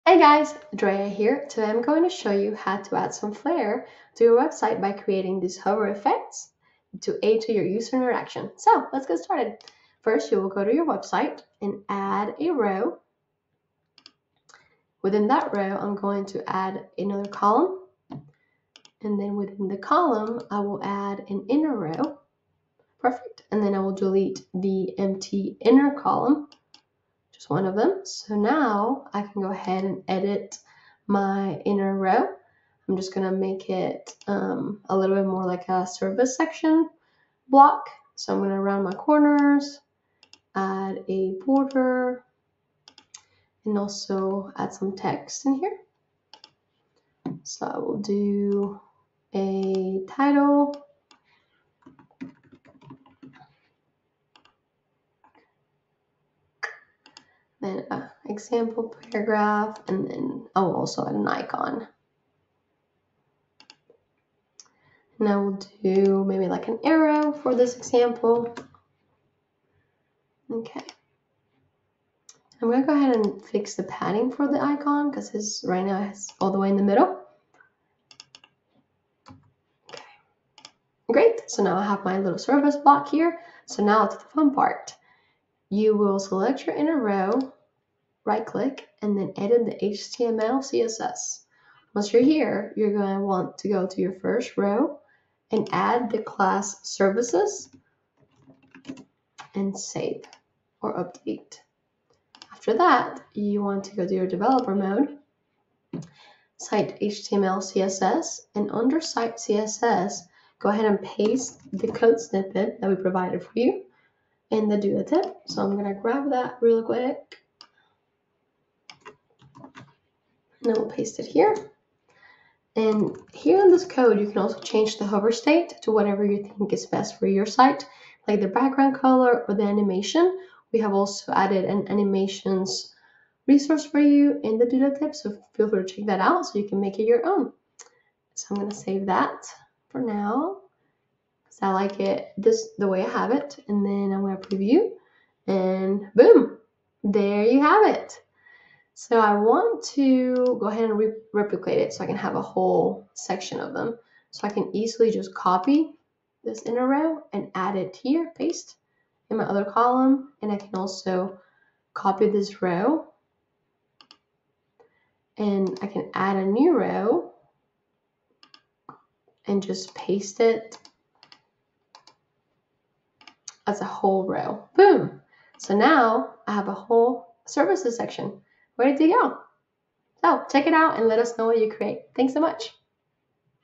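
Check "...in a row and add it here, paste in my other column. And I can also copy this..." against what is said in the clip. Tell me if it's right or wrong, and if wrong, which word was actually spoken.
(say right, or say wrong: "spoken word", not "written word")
right.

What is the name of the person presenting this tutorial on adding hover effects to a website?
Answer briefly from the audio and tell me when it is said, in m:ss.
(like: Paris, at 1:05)
Drea, at 0:00.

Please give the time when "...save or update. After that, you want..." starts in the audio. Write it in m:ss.
1:39.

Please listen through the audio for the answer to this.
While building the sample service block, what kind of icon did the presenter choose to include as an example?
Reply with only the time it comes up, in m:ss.
1:06.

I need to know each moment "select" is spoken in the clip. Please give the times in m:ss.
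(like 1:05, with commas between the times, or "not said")
1:26.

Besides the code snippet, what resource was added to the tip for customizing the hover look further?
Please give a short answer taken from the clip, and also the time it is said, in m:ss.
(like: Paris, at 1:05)
An animations resource, at 2:11.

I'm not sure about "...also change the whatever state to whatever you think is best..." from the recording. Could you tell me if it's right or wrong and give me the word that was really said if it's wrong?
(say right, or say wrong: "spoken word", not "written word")
wrong: "hover", not "whatever".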